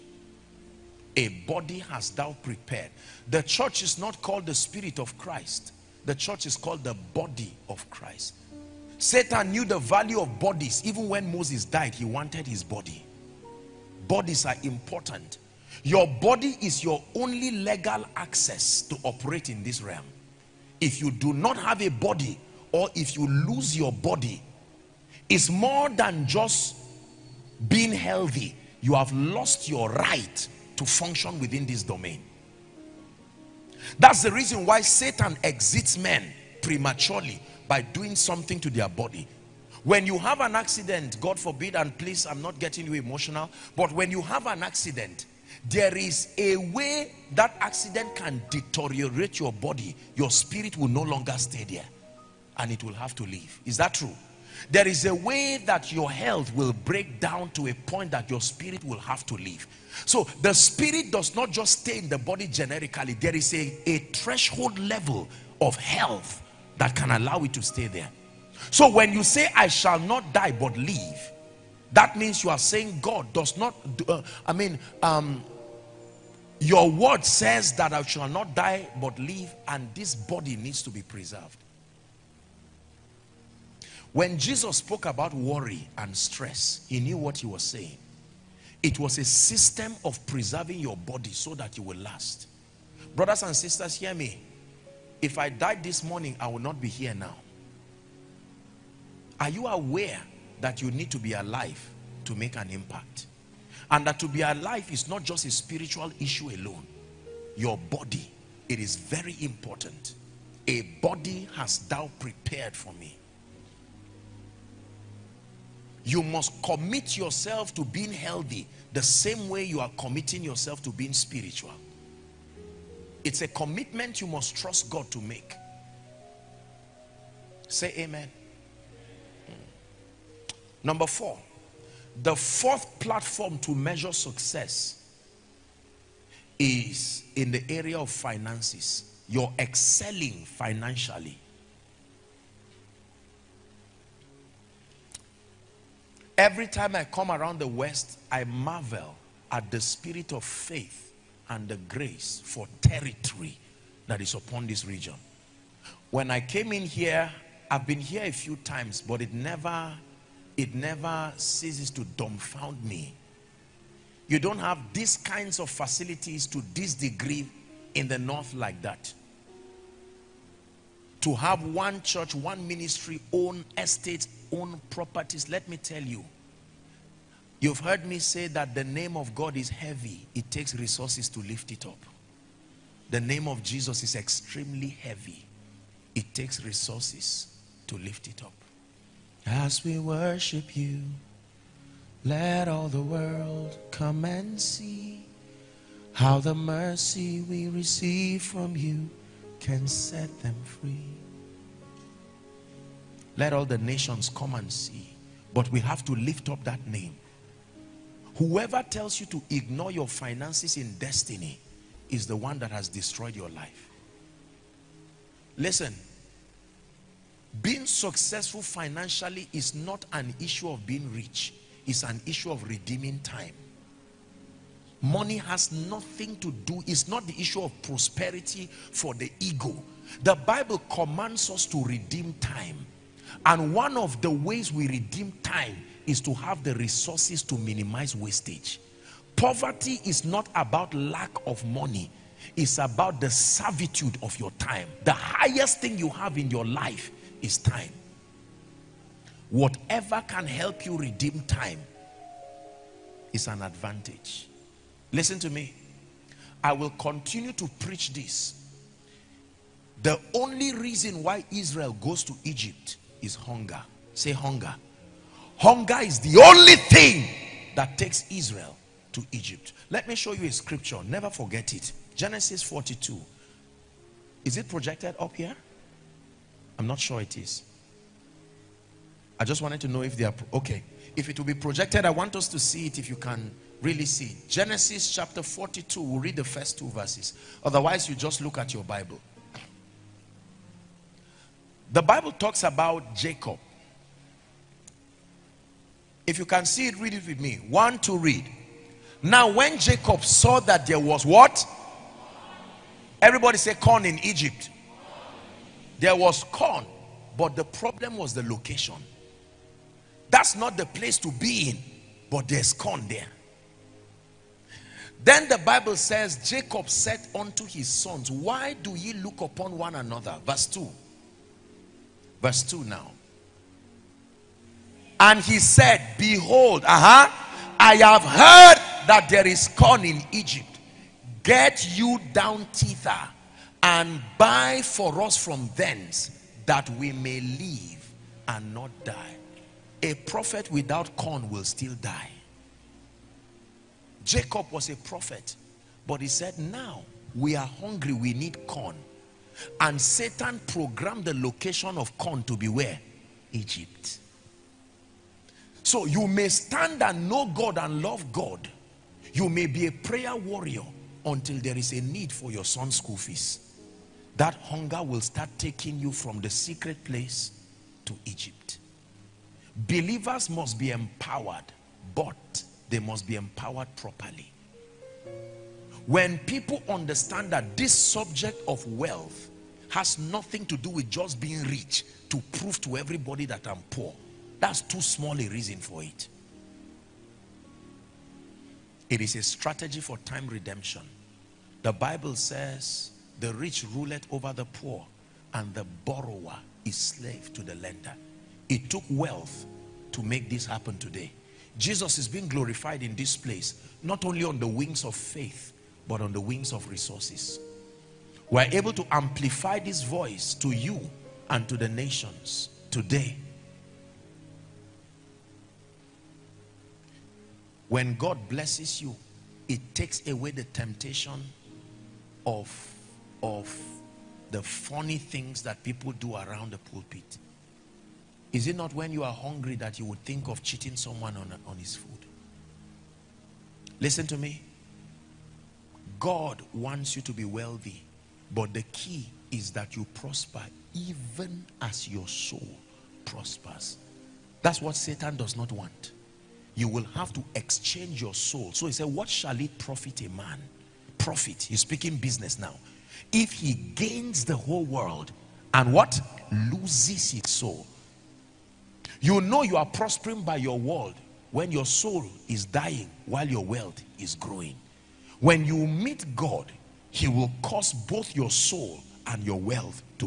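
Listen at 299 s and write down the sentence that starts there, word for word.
Now, when Jacob saw that there was what?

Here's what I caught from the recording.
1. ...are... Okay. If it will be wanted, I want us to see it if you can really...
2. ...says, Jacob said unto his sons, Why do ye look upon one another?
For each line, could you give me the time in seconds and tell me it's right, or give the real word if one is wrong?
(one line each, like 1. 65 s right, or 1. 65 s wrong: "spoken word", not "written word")
1. 280 s wrong: "projected", not "wanted"
2. 315 s right.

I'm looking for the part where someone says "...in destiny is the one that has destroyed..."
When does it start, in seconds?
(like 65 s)
210 s.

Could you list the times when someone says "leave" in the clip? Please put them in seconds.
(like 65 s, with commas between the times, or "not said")
53 s, 59 s.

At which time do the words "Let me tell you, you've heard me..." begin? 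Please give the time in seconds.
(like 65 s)
175 s.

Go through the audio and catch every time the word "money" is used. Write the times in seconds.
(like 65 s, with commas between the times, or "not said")
225 s, 241 s.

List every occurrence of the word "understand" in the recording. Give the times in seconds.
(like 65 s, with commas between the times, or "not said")
376 s.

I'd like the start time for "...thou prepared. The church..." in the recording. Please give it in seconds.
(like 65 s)
2 s.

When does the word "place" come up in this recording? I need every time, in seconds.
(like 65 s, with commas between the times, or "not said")
310 s, 367 s, 403 s.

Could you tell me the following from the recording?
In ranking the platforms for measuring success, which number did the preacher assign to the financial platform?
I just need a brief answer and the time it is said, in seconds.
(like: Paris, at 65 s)
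4, at 130 s.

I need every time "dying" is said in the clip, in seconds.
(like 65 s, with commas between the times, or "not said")
462 s.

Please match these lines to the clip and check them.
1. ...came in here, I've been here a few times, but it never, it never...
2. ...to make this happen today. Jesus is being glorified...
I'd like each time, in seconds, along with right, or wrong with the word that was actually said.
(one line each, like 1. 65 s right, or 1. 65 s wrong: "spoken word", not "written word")
1. 156 s right
2. 400 s right.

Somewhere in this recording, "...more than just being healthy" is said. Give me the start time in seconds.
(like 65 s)
25 s.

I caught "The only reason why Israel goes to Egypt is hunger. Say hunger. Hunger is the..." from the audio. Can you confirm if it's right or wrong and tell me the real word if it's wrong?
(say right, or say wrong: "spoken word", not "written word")
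right.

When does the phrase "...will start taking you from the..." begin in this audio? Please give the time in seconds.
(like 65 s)
365 s.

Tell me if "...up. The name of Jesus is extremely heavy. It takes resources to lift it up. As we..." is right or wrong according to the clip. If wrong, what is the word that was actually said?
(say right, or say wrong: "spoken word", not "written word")
right.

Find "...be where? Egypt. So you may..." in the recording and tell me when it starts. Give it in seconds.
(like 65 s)
352 s.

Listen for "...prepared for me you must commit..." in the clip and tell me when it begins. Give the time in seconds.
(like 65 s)
112 s.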